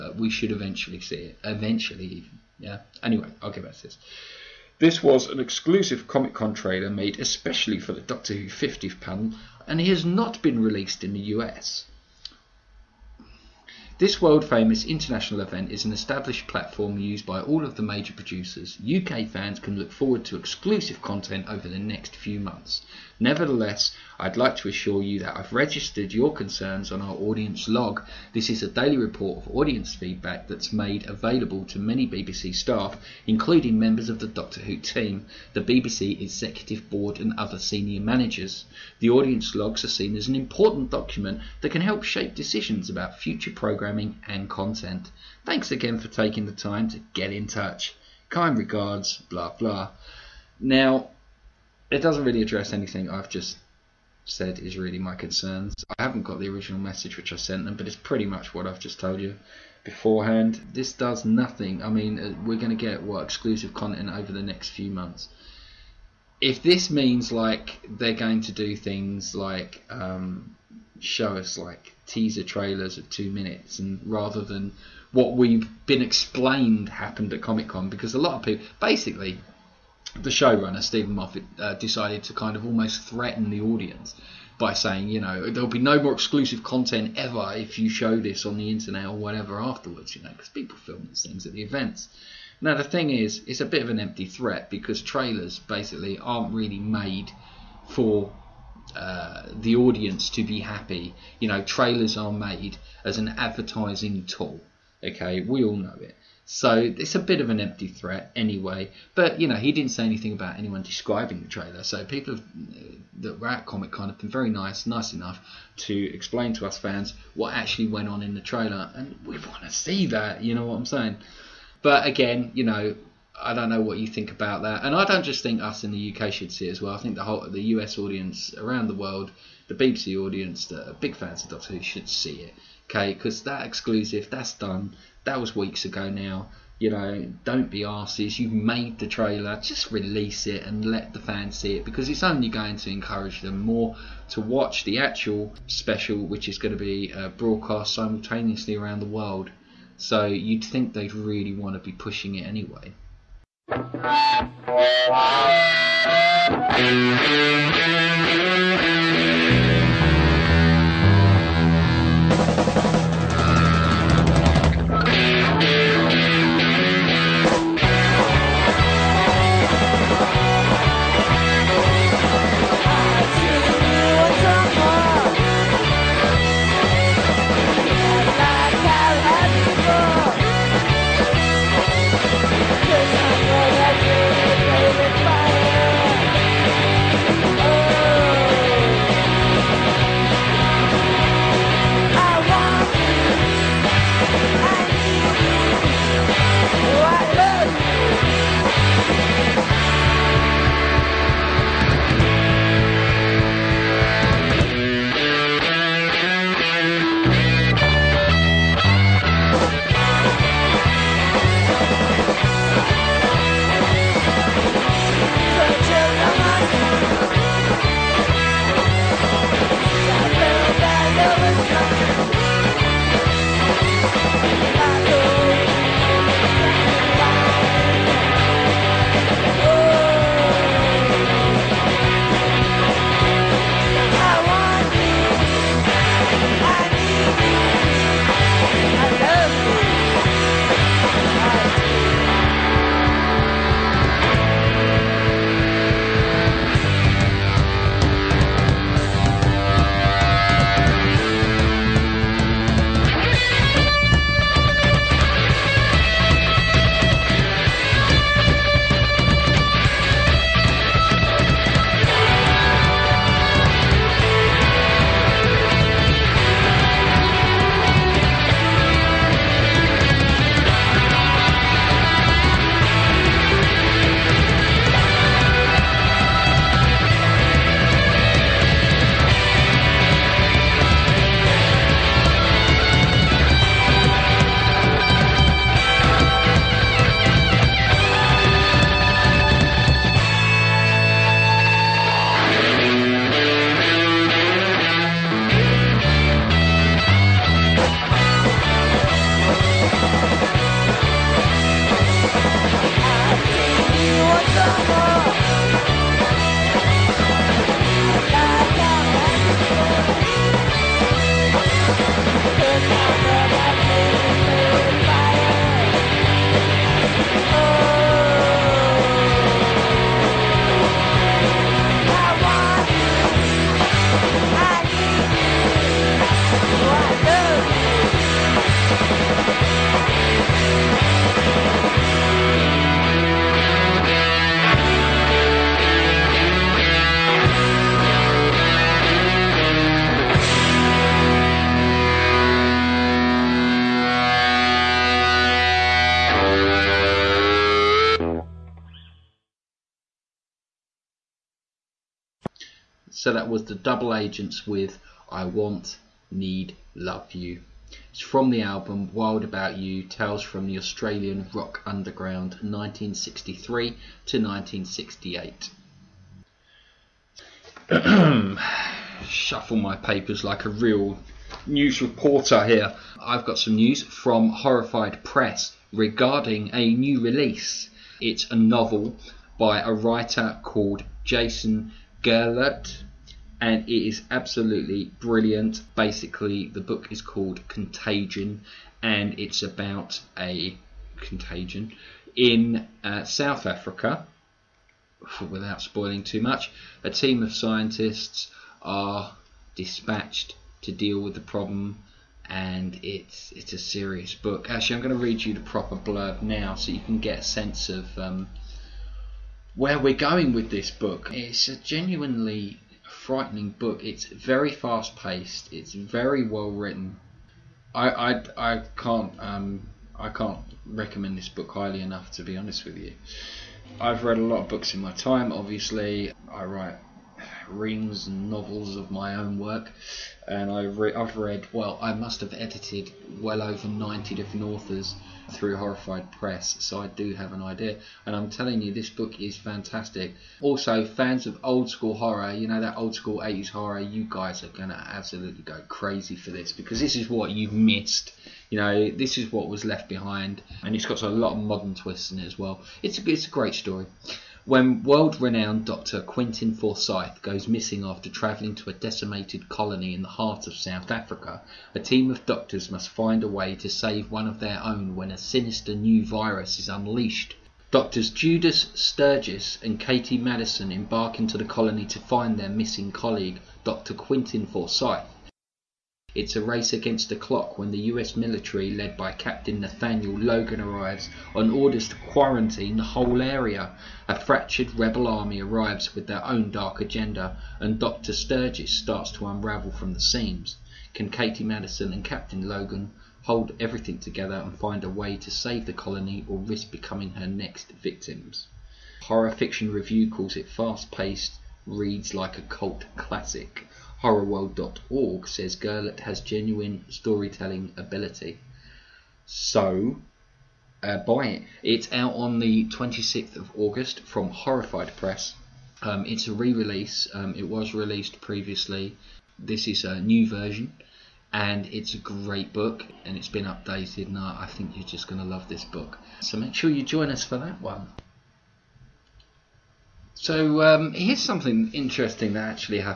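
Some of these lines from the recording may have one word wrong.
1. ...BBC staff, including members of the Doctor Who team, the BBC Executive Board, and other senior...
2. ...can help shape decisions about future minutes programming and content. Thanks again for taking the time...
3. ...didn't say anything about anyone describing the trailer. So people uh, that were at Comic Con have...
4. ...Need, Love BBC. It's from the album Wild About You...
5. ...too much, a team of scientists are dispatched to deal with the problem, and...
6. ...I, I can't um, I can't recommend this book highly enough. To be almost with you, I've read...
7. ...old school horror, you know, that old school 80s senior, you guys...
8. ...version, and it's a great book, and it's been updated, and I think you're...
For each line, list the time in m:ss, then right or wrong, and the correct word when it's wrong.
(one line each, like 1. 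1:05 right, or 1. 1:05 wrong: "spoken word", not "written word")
1. 0:32 right
2. 0:41 wrong: "programmes", not "minutes"
3. 1:49 right
4. 5:56 wrong: "You", not "BBC"
5. 6:36 right
6. 6:58 wrong: "honest", not "almost"
7. 7:21 wrong: "horror", not "senior"
8. 8:40 right.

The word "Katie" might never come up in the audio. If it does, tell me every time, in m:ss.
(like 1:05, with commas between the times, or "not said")
7:49, 8:11.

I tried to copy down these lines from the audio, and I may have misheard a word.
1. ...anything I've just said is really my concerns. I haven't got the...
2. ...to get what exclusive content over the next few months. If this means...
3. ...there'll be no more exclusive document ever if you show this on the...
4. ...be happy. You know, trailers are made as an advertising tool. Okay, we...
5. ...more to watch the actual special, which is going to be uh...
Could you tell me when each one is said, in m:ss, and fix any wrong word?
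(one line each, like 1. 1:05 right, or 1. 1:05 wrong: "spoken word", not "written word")
1. 0:52 right
2. 1:02 right
3. 1:25 wrong: "content", not "document"
4. 1:40 right
5. 2:23 right.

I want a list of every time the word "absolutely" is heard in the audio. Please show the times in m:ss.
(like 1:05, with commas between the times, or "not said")
6:24, 7:24.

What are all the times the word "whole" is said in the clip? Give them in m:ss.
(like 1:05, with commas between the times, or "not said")
2:07, 8:03.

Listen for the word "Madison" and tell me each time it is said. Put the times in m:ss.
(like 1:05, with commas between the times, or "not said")
7:50, 8:11.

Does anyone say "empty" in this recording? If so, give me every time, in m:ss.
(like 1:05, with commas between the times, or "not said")
1:33, 1:47.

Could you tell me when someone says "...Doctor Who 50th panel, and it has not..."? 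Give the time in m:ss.
0:08.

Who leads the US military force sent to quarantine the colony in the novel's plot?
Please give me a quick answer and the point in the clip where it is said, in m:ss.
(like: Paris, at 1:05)
Captain Nathaniel Logan, at 7:59.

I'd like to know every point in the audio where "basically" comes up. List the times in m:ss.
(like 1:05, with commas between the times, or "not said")
1:18, 1:35, 6:25.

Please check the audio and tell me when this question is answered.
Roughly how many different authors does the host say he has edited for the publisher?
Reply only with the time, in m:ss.
7:13.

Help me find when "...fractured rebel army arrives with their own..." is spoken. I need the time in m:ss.
8:04.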